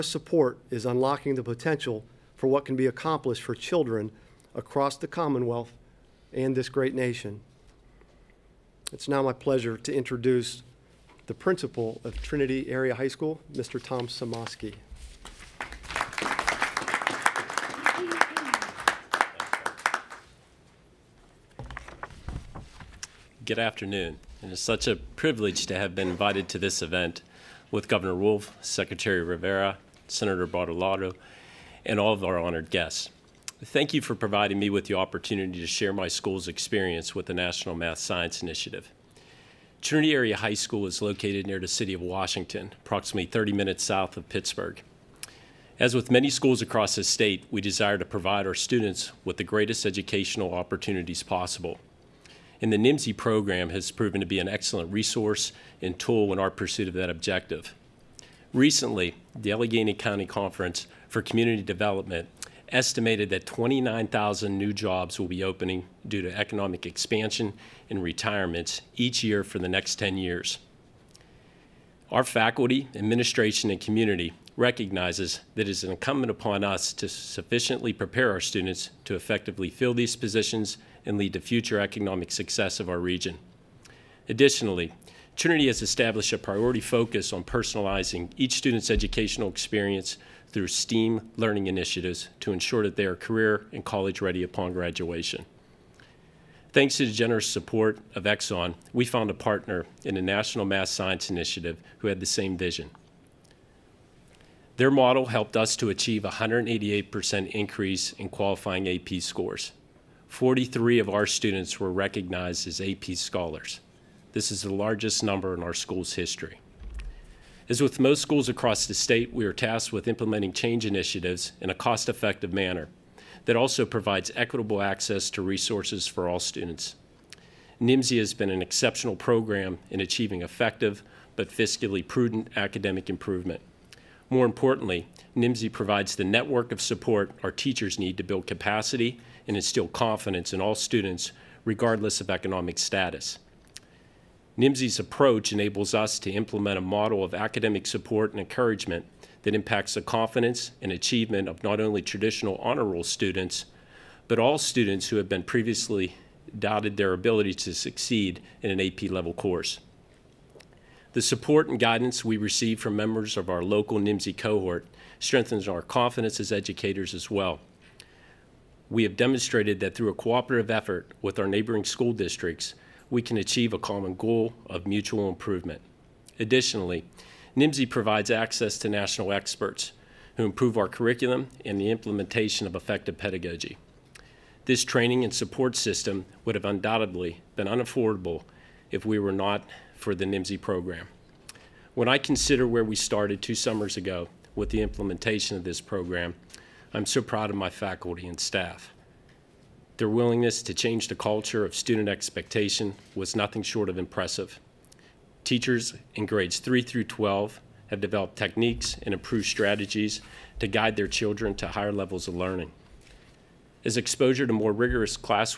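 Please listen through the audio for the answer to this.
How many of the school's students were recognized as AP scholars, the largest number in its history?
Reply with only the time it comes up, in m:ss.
1:50.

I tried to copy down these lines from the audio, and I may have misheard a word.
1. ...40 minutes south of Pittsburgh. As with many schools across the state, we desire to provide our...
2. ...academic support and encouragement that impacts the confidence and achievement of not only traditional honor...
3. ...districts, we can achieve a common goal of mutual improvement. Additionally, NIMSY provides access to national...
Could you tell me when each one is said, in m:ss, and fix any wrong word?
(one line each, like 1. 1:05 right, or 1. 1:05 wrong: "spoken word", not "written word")
1. 0:43 wrong: "30", not "40"
2. 2:27 right
3. 2:52 right.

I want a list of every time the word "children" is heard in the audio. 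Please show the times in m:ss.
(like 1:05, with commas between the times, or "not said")
0:03, 3:31.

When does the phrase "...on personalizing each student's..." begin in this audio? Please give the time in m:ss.
1:27.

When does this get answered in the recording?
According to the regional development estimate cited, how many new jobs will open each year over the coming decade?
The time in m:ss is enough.
1:03.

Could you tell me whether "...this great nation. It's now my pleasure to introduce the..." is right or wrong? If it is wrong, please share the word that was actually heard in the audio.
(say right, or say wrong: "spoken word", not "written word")
right.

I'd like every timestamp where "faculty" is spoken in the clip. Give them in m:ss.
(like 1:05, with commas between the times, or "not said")
1:12, 3:17.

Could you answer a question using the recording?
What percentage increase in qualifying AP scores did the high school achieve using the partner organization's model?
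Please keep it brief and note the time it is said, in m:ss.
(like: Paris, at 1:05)
188%, at 1:46.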